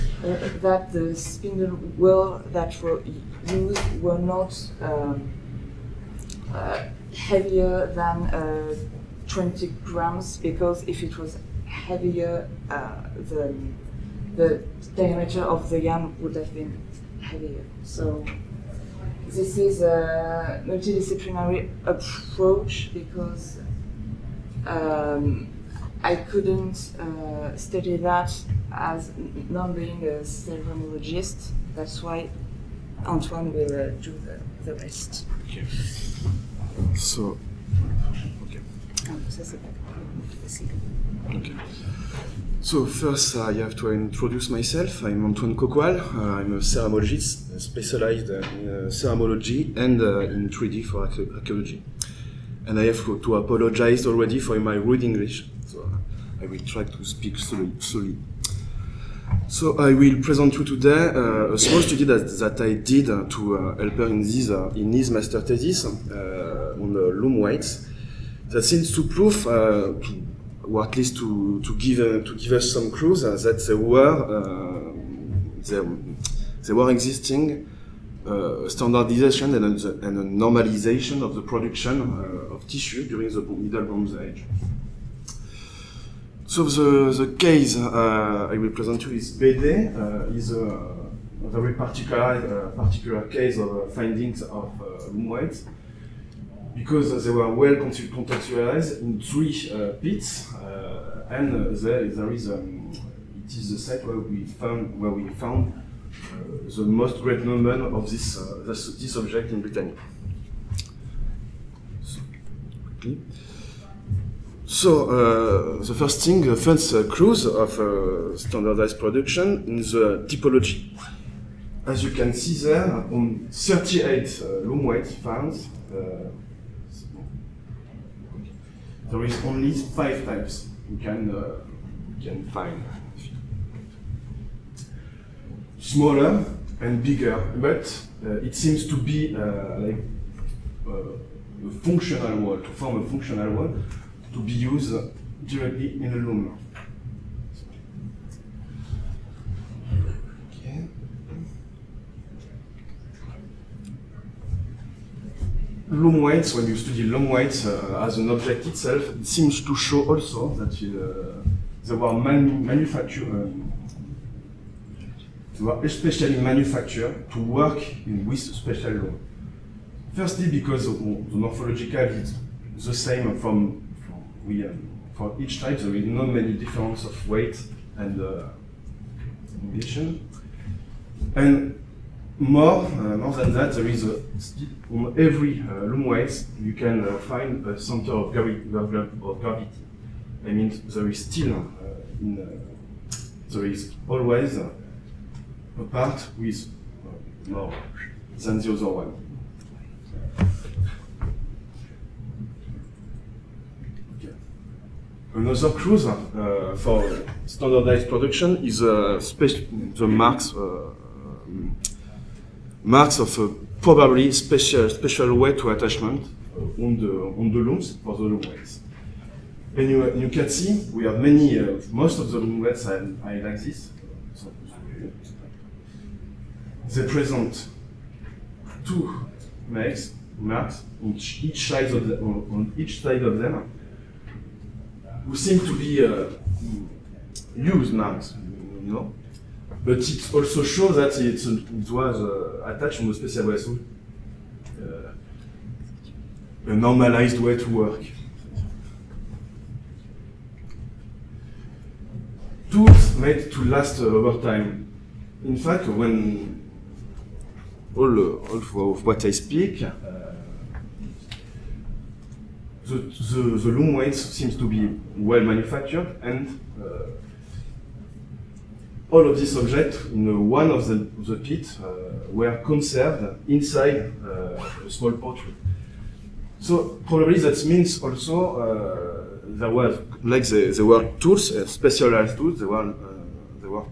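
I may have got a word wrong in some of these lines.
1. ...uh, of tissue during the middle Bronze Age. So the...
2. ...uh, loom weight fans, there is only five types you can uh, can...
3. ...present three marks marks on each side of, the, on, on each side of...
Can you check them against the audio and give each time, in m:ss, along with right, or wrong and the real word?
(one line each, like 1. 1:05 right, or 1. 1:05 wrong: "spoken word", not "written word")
1. 1:22 right
2. 2:04 right
3. 3:47 wrong: "two", not "three".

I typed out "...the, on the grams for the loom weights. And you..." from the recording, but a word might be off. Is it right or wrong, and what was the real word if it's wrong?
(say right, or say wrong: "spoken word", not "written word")
wrong: "looms", not "grams".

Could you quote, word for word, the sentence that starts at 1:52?
So, So uh, the first thing, the first uh, of uh, standardized production in the typology.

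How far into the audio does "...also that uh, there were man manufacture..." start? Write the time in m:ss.
2:40.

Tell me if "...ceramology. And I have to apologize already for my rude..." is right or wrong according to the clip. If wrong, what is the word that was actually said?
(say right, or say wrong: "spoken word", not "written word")
wrong: "archaeology", not "ceramology".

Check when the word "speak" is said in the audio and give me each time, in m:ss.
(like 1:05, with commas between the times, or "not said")
0:57, 4:19.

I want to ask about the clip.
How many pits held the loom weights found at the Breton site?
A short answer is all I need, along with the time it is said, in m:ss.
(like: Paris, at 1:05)
3, at 1:39.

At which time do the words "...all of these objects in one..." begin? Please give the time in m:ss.
4:29.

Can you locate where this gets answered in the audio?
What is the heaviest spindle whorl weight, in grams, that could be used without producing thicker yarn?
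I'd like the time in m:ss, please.
0:09.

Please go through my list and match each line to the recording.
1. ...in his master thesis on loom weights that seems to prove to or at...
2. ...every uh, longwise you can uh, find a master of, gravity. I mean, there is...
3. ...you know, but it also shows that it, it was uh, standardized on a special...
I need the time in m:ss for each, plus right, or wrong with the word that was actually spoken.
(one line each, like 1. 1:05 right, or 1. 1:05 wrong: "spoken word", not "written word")
1. 1:04 right
2. 3:05 wrong: "center", not "master"
3. 3:58 wrong: "attached", not "standardized".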